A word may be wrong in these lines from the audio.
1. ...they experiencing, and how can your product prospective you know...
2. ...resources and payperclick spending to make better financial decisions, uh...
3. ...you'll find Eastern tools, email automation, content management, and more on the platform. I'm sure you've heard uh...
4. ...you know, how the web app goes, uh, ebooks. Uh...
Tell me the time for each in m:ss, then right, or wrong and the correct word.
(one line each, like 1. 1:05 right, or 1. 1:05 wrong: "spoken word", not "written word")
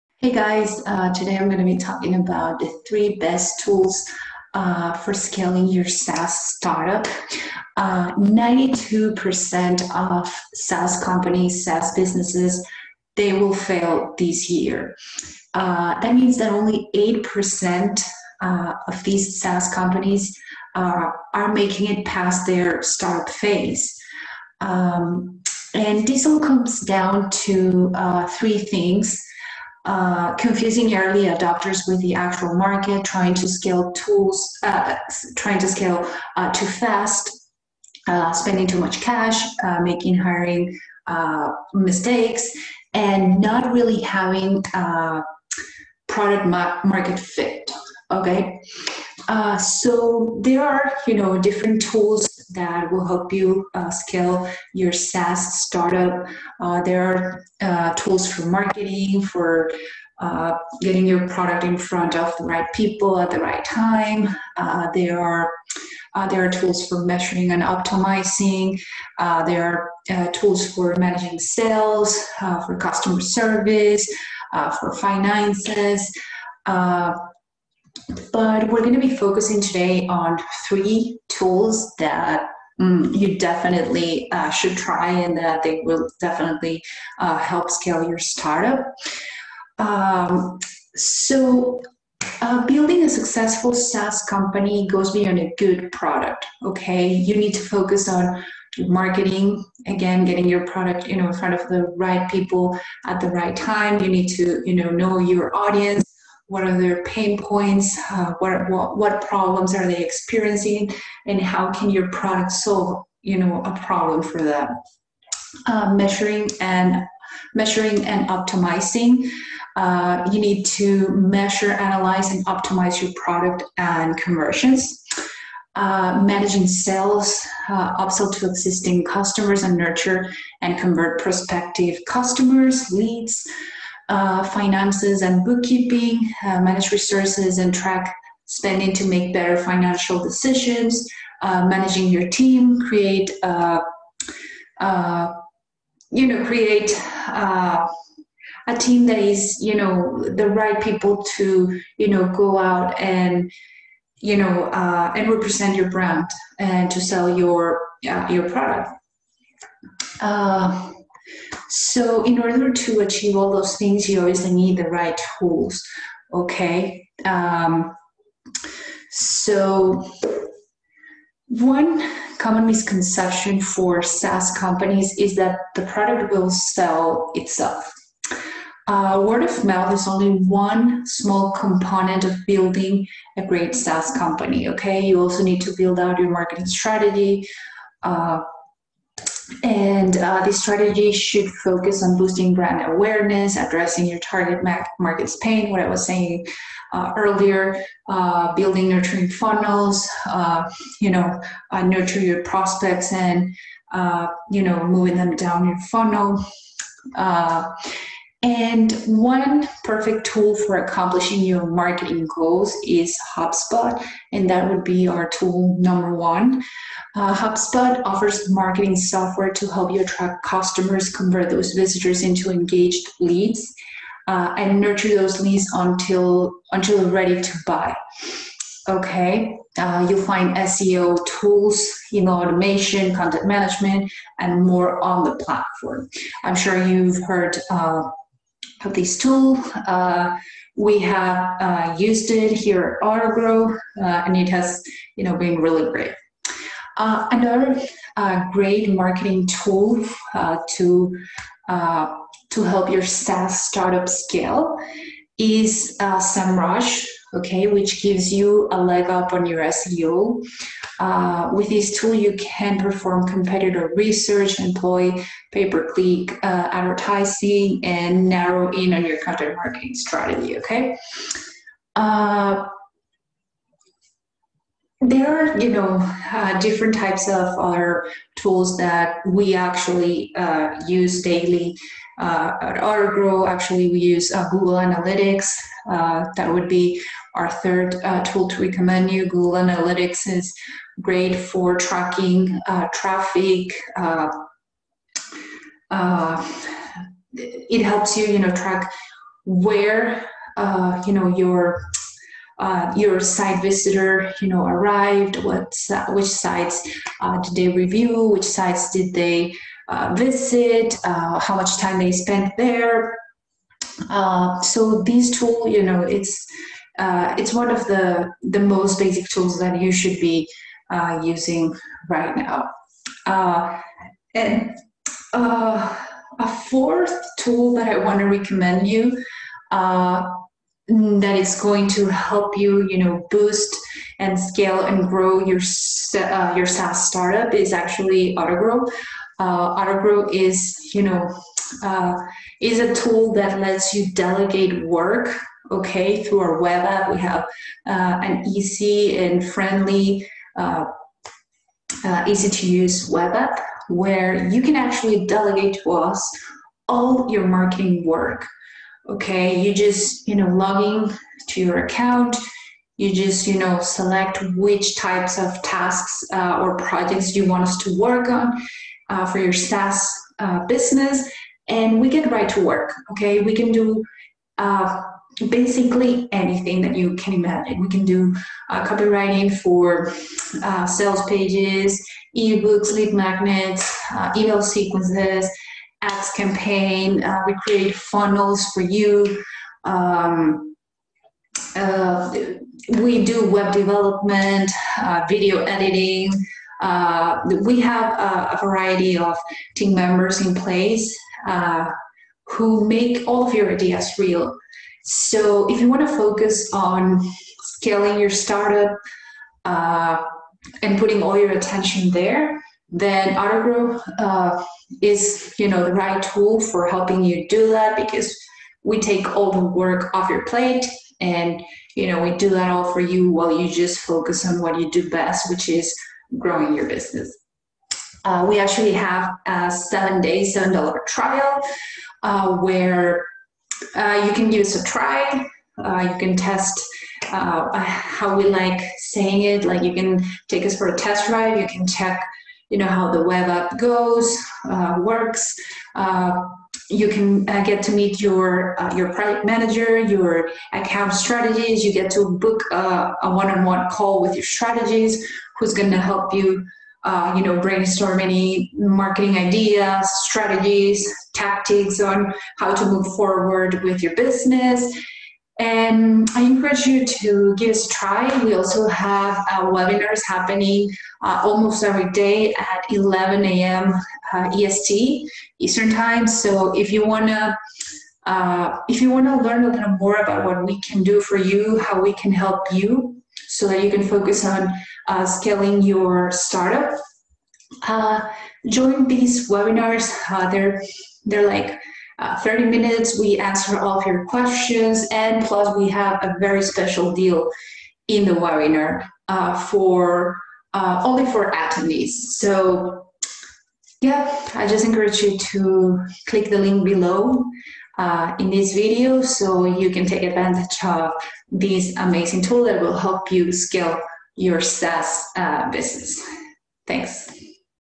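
1. 1:49 wrong: "solve", not "prospective"
2. 2:16 wrong: "track", not "payperclick"
3. 3:50 wrong: "SEO", not "Eastern"
4. 7:22 wrong: "works", not "ebooks".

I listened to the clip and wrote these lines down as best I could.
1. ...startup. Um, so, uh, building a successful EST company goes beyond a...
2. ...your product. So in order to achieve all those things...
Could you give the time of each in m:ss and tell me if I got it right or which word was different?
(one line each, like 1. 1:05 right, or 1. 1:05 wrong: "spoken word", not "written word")
1. 1:28 wrong: "SaaS", not "EST"
2. 2:38 right.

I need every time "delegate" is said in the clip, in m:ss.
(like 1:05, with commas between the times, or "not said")
5:44, 5:55.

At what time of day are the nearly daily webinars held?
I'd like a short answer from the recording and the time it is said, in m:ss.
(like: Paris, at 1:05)
11 a.m. EST, at 7:52.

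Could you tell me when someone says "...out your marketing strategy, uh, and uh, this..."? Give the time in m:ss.
3:05.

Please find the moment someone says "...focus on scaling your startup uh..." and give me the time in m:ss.
6:46.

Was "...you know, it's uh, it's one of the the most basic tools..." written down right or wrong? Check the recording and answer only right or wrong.
right.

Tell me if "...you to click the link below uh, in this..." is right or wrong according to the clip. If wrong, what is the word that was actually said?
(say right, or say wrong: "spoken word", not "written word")
right.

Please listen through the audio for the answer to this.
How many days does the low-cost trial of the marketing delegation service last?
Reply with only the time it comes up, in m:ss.
7:09.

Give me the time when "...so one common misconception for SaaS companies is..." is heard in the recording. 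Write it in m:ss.
2:49.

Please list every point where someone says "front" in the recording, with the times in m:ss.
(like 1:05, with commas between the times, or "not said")
1:01, 1:41.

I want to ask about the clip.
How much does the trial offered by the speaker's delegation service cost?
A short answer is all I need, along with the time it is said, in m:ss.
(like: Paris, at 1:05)
$7, at 7:10.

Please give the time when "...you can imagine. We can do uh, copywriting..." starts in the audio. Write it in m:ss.
6:16.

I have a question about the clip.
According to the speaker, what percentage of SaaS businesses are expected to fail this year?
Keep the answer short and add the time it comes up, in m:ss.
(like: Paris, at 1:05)
92%, at 0:07.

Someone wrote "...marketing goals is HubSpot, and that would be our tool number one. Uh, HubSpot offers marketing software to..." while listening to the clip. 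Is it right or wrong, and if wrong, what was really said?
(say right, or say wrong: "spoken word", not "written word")
right.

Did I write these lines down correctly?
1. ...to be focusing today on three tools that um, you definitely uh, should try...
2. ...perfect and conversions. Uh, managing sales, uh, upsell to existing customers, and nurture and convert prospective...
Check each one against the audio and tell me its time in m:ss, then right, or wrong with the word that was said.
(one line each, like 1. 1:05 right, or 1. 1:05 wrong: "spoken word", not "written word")
1. 1:18 right
2. 2:03 wrong: "product", not "perfect".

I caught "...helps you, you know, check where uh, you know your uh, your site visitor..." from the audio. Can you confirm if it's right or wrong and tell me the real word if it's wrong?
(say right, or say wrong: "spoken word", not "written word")
wrong: "track", not "check".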